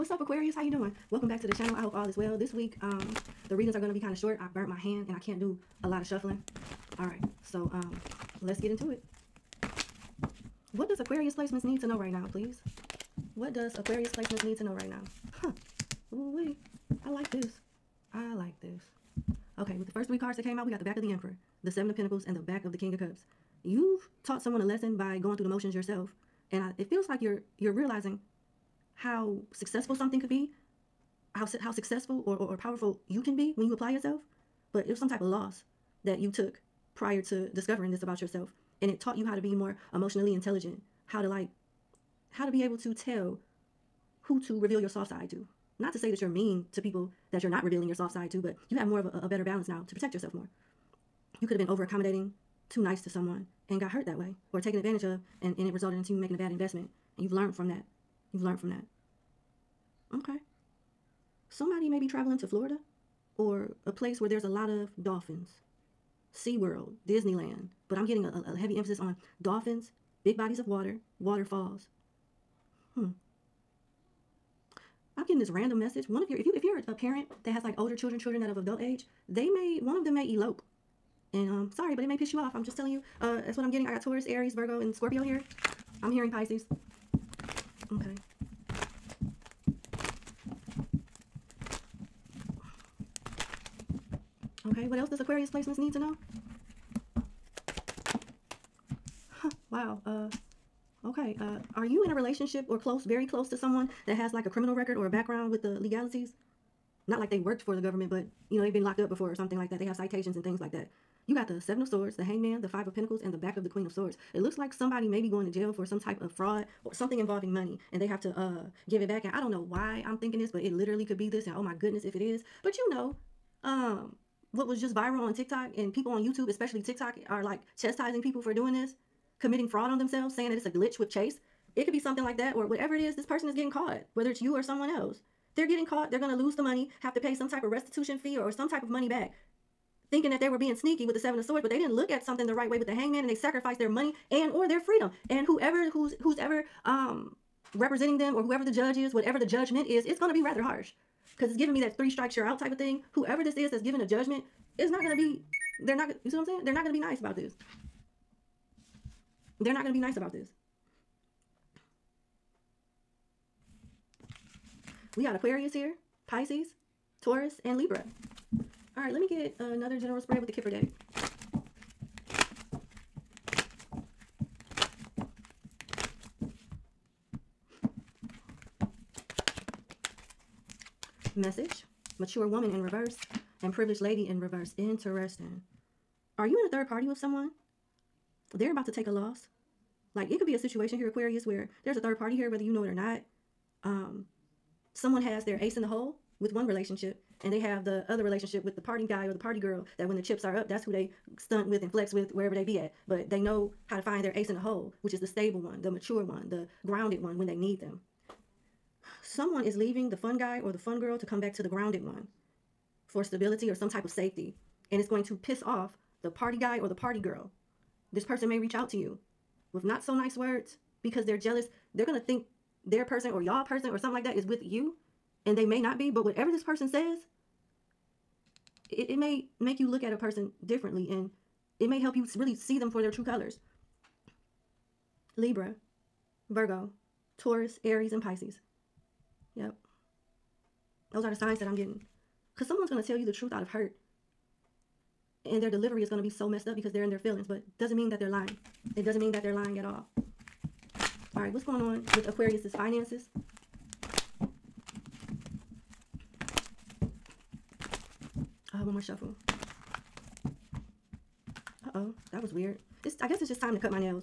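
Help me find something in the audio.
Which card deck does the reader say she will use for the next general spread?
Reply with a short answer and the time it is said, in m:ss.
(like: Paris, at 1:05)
Kipper deck, at 2:50.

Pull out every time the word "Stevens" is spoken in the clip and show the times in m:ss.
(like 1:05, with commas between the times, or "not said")
not said.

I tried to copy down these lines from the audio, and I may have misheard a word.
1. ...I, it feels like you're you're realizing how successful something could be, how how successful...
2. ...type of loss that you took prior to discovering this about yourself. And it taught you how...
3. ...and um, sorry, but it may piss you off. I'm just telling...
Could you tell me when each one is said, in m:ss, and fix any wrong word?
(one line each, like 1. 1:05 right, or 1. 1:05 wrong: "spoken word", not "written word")
1. 0:26 right
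2. 0:35 right
3. 1:21 right.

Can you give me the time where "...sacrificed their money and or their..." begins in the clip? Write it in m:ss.
2:23.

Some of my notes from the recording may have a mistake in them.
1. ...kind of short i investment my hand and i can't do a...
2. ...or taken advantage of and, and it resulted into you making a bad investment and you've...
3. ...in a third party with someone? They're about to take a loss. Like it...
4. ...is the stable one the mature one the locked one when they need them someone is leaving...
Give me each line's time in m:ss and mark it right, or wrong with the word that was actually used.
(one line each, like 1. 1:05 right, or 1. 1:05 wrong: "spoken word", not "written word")
1. 0:03 wrong: "burnt", not "investment"
2. 0:54 right
3. 3:06 right
4. 3:25 wrong: "grounded", not "locked".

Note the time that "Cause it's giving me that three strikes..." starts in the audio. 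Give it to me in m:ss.
2:31.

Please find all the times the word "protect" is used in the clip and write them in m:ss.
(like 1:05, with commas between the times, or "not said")
0:49.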